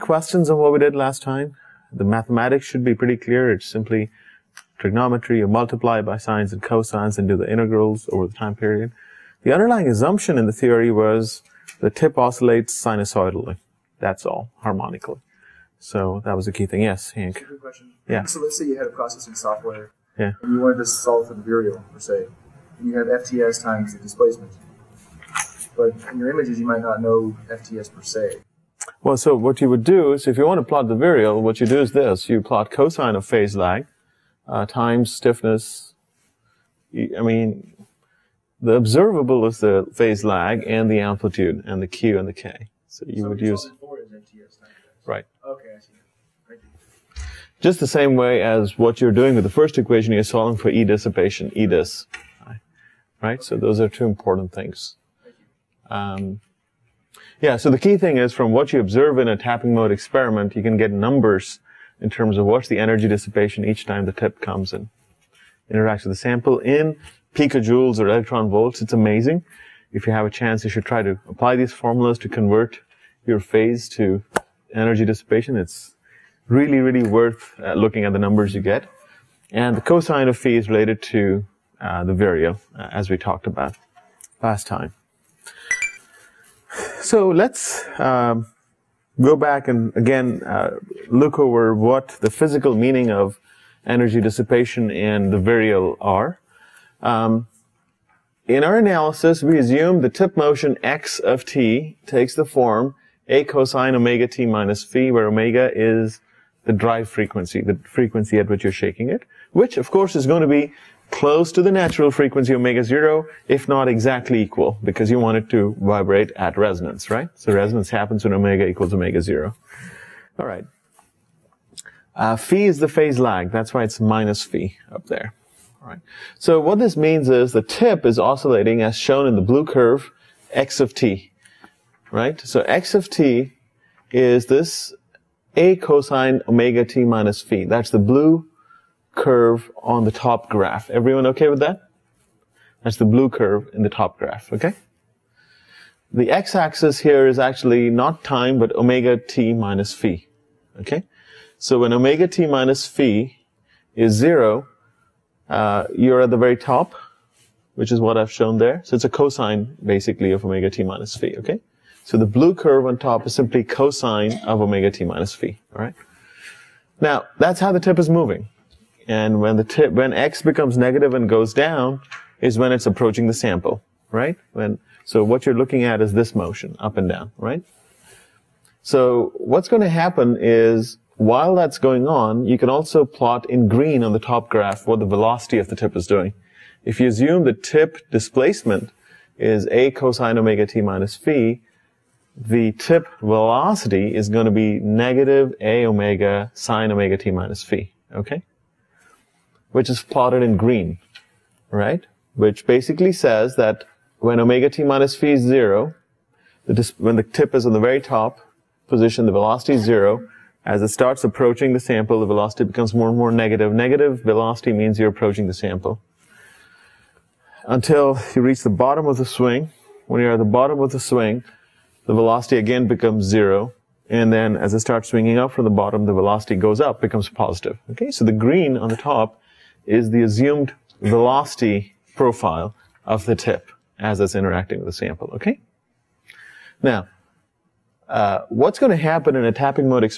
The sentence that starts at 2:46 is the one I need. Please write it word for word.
Now, that's how the tip is moving.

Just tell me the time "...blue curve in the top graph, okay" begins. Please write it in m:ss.
2:23.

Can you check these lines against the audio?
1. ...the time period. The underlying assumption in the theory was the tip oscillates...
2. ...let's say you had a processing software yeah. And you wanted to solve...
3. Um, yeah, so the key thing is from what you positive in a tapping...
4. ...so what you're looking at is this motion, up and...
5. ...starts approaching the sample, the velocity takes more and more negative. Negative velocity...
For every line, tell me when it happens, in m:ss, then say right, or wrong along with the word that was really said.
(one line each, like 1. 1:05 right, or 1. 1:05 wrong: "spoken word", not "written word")
1. 0:08 right
2. 0:18 right
3. 0:55 wrong: "observe", not "positive"
4. 2:55 right
5. 3:30 wrong: "becomes", not "takes".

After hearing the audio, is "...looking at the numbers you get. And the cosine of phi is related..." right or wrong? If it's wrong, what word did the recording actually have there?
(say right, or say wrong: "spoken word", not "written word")
right.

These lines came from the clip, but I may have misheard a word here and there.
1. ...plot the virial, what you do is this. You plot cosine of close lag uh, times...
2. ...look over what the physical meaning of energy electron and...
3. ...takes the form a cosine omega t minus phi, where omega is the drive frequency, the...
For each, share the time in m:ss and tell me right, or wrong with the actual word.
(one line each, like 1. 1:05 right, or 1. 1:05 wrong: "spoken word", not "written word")
1. 0:30 wrong: "phase", not "close"
2. 1:31 wrong: "dissipation", not "electron"
3. 1:42 right.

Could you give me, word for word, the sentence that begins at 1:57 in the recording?
So resonance happens when omega equals omega zero.